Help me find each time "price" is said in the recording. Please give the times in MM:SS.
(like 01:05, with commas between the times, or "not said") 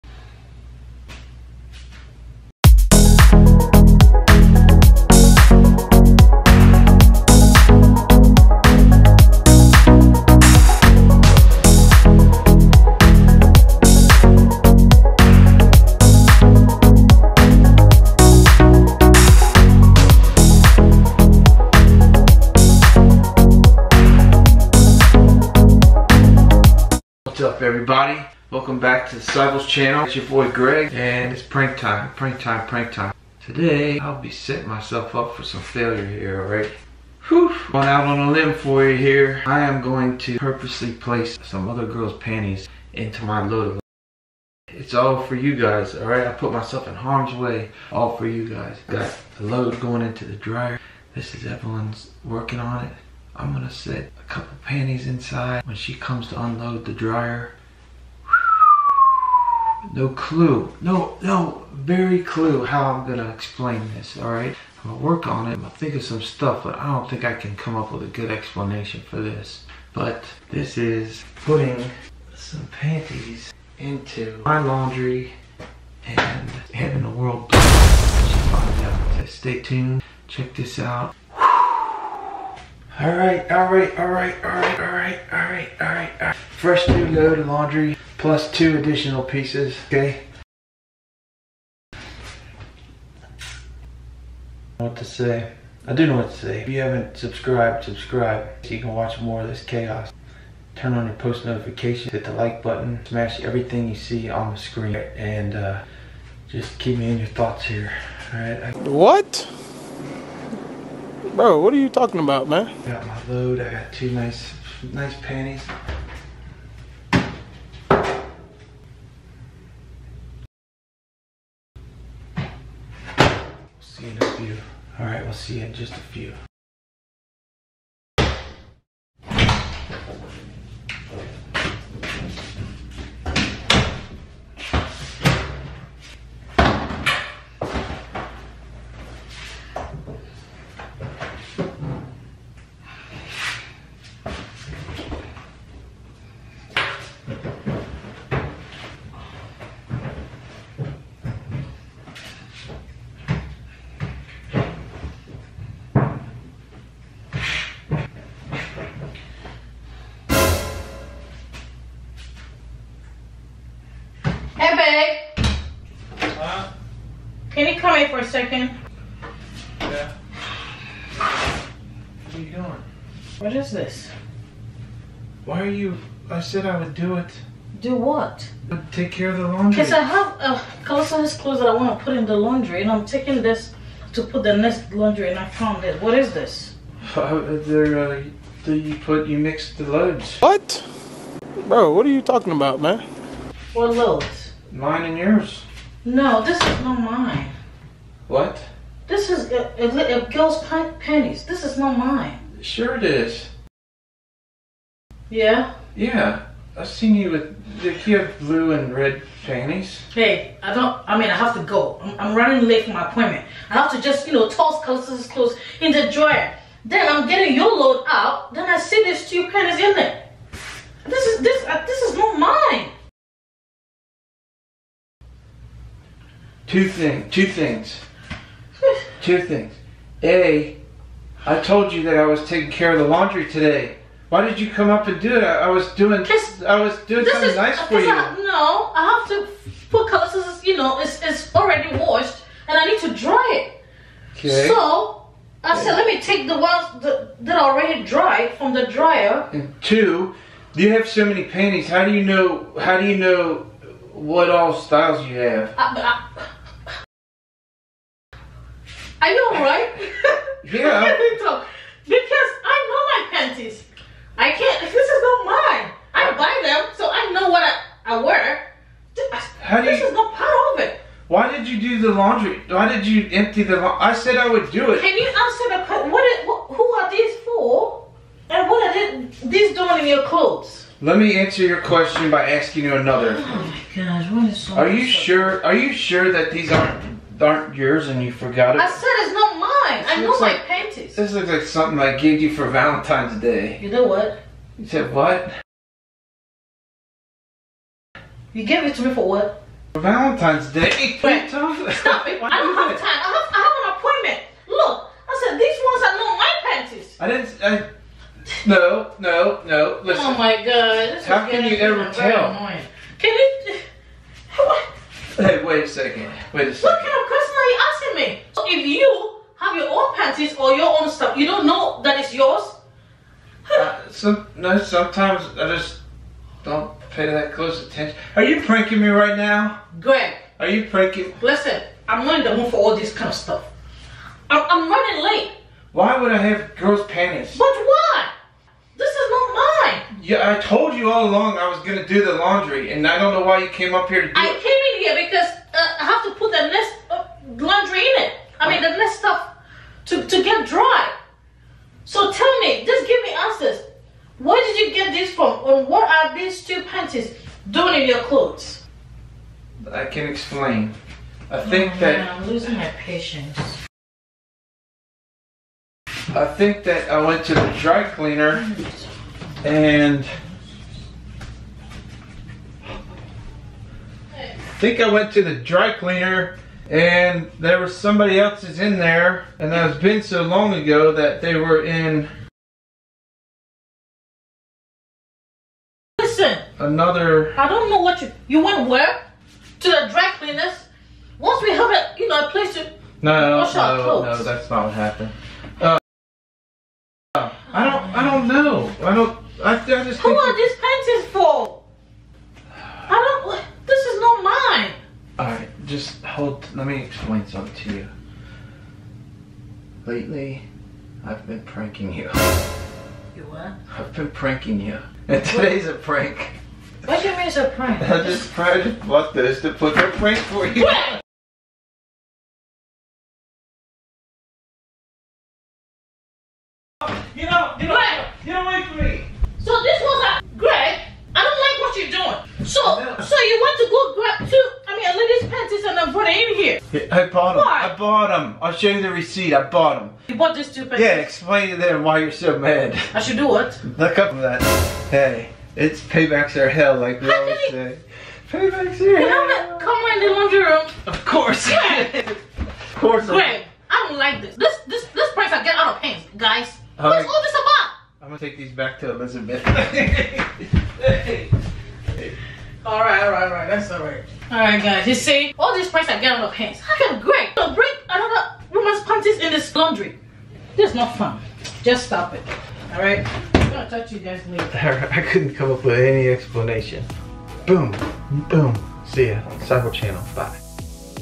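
07:35, 07:45.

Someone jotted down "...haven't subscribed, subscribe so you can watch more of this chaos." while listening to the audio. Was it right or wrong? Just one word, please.
right.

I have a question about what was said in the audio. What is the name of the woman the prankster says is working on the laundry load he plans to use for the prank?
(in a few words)
Evelyn.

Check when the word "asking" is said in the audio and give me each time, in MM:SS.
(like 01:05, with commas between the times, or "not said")
04:42, 05:17.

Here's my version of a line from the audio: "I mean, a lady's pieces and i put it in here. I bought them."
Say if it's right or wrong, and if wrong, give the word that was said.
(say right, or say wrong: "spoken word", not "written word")
wrong: "panties", not "pieces".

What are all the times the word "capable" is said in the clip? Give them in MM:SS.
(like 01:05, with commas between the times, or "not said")
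not said.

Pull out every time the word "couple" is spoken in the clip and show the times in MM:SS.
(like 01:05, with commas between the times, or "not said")
00:54.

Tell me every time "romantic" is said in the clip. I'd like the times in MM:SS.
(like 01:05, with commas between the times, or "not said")
not said.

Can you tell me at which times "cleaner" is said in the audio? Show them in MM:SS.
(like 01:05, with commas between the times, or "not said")
06:08, 06:15, 06:30.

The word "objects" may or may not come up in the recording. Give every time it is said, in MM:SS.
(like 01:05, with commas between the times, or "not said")
not said.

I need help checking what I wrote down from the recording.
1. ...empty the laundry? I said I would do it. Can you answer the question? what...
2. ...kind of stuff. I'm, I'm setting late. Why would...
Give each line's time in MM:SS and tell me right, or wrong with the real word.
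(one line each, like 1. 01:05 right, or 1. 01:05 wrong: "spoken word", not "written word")
1. 04:33 right
2. 05:33 wrong: "running", not "setting".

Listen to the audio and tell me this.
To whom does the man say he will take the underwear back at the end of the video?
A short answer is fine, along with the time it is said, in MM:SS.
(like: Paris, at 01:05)
Elizabeth, at 07:39.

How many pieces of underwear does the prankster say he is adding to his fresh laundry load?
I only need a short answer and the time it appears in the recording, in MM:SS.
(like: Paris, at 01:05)
2, at 01:28.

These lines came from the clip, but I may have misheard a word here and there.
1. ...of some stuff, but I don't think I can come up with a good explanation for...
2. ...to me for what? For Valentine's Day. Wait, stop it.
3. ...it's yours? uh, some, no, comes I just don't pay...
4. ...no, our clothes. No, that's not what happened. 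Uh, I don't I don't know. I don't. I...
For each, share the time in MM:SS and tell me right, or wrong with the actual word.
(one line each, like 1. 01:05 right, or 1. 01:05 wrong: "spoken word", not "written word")
1. 01:05 right
2. 04:58 right
3. 05:22 wrong: "sometimes", not "comes"
4. 06:33 right.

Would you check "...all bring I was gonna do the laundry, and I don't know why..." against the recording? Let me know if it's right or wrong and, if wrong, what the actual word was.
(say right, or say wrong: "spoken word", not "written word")
wrong: "along", not "bring".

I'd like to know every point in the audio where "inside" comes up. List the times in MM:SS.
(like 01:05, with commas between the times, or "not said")
00:55.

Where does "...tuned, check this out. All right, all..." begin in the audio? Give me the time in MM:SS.
01:19.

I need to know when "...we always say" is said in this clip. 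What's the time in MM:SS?
07:27.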